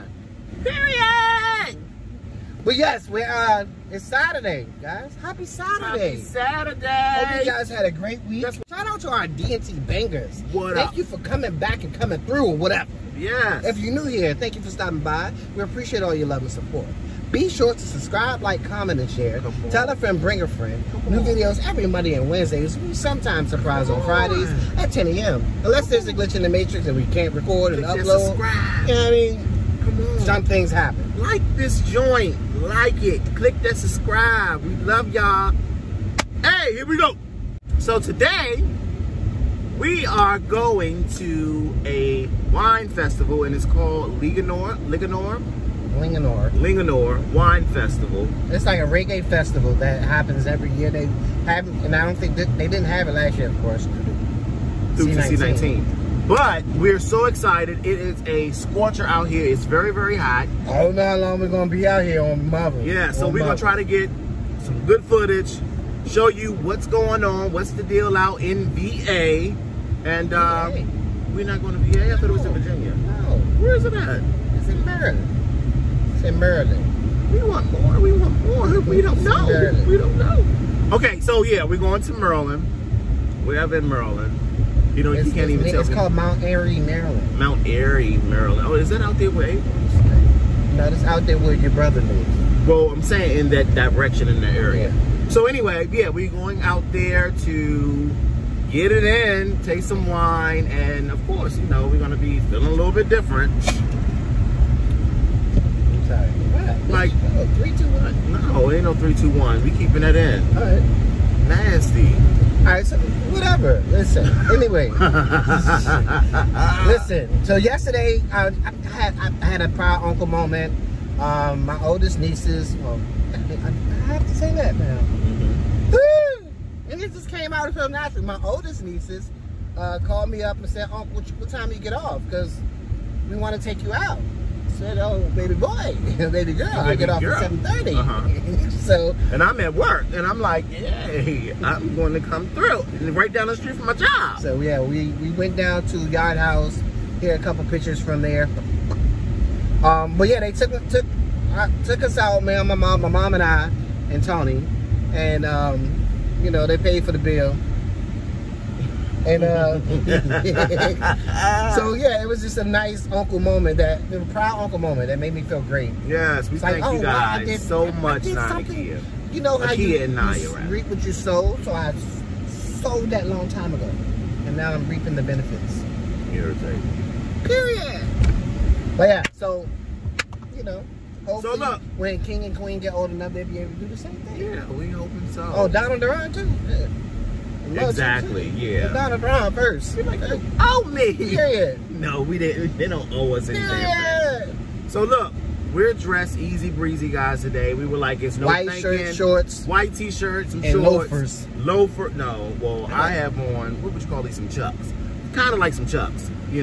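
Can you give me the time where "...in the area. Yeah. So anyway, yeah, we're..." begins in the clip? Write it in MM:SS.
01:34.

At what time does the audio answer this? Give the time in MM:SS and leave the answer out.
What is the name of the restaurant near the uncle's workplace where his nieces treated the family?
02:26.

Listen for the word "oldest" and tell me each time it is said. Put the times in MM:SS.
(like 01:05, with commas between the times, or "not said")
02:01, 02:08.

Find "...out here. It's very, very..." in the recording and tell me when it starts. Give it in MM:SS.
00:59.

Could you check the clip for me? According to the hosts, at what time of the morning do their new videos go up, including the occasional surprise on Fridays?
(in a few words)
10 a.m.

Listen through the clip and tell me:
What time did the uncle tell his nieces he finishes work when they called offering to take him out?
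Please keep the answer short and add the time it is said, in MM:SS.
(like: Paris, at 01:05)
7:30, at 02:17.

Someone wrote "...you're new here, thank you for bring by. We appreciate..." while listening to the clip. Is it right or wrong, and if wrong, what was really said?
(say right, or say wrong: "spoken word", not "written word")
wrong: "stopping", not "bring".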